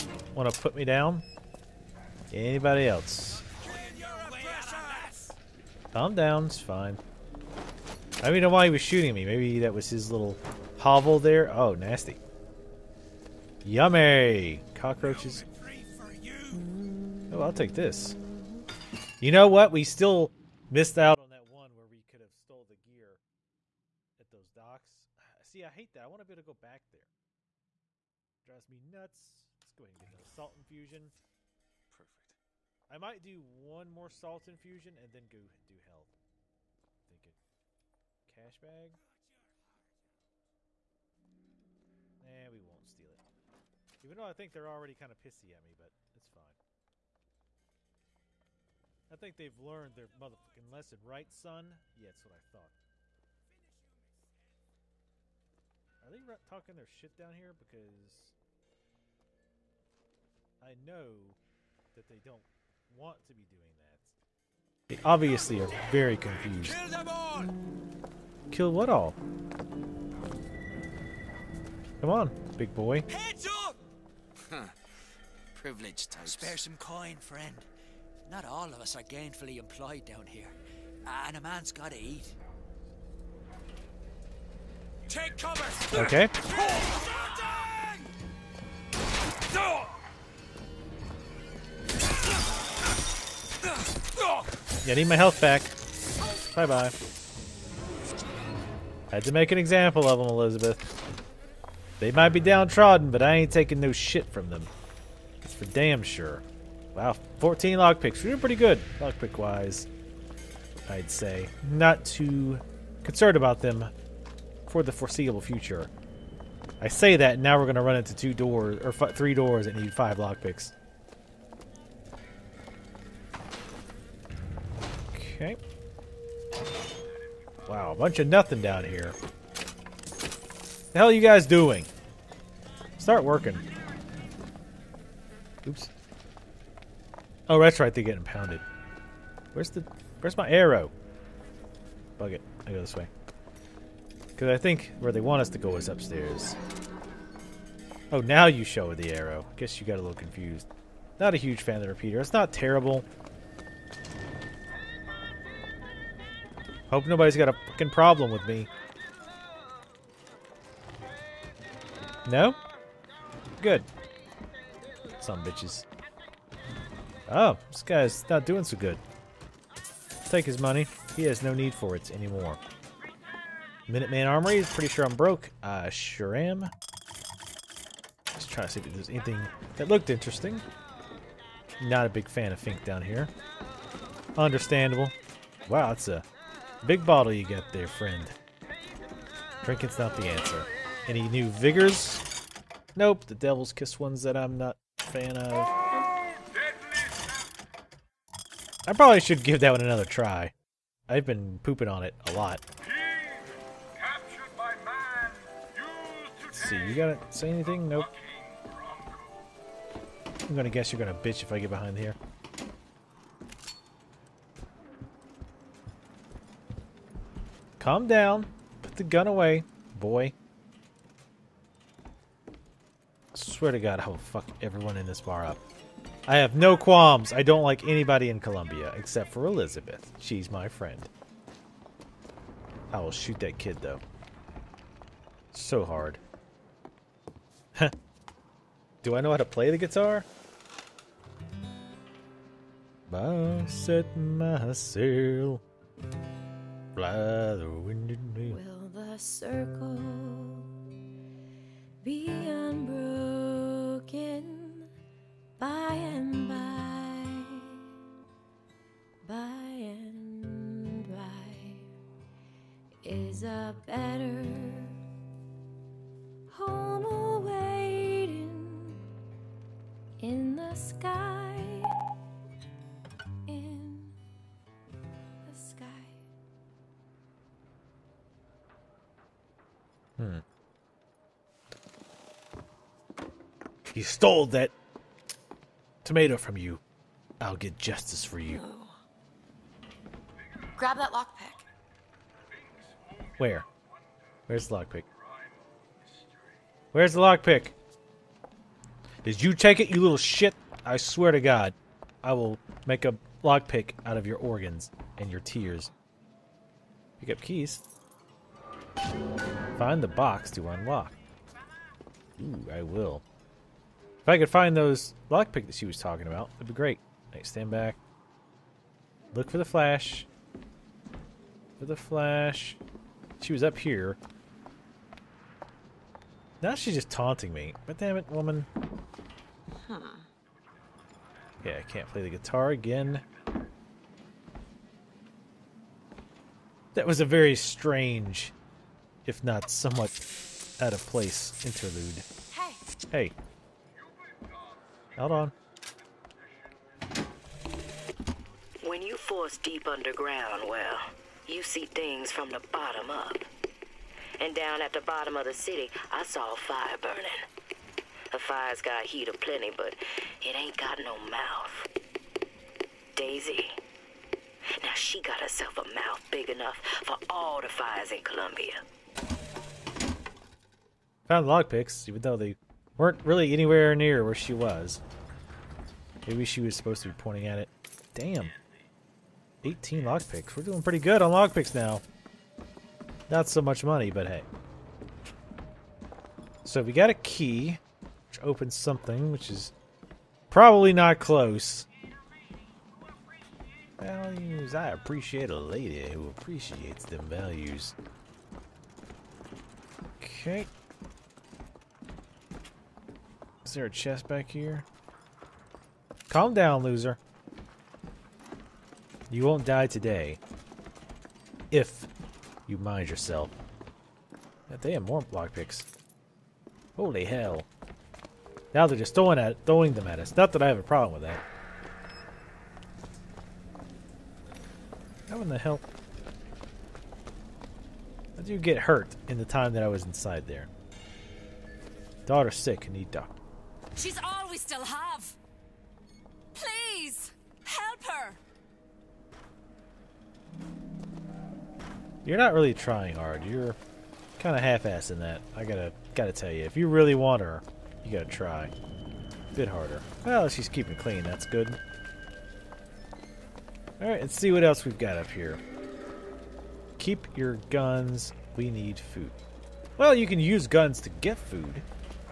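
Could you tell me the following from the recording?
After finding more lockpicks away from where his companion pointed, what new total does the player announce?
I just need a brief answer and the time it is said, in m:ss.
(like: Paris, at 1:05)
18, at 6:19.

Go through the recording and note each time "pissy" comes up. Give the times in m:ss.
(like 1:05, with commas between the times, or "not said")
0:45.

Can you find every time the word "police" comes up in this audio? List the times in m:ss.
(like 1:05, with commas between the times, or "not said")
not said.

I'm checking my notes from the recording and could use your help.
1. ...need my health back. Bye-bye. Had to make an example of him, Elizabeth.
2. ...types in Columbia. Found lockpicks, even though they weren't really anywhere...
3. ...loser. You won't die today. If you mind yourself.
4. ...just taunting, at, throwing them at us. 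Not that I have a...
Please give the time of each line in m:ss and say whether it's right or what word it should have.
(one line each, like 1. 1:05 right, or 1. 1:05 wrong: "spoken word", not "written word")
1. 1:34 right
2. 6:07 wrong: "fires", not "types"
3. 6:46 right
4. 6:58 wrong: "throwing", not "taunting".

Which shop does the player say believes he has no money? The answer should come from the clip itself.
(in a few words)
Minuteman Armory.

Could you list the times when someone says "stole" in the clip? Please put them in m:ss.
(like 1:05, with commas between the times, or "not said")
0:22, 4:44.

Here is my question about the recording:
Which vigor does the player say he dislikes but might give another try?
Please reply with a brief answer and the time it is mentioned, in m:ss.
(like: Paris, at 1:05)
Devil's Kiss, at 3:13.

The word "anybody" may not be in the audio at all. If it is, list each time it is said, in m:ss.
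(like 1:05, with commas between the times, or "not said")
0:02, 3:47.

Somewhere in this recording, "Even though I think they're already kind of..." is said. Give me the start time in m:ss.
0:44.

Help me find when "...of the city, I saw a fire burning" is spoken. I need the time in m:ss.
5:55.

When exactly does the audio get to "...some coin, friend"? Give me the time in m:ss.
1:16.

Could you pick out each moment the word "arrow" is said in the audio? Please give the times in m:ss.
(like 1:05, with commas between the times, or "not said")
2:20, 2:29.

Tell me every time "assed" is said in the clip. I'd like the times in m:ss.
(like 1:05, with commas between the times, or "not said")
7:24.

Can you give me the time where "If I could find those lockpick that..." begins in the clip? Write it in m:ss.
5:14.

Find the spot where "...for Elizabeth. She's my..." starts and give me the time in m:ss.
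3:49.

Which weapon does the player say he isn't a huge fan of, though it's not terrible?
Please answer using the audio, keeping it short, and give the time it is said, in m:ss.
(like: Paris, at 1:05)
The repeater, at 2:31.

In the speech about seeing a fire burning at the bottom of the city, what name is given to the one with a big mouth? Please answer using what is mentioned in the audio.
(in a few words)
Daisy.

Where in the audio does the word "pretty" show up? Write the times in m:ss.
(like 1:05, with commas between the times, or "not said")
1:48, 2:54, 6:20.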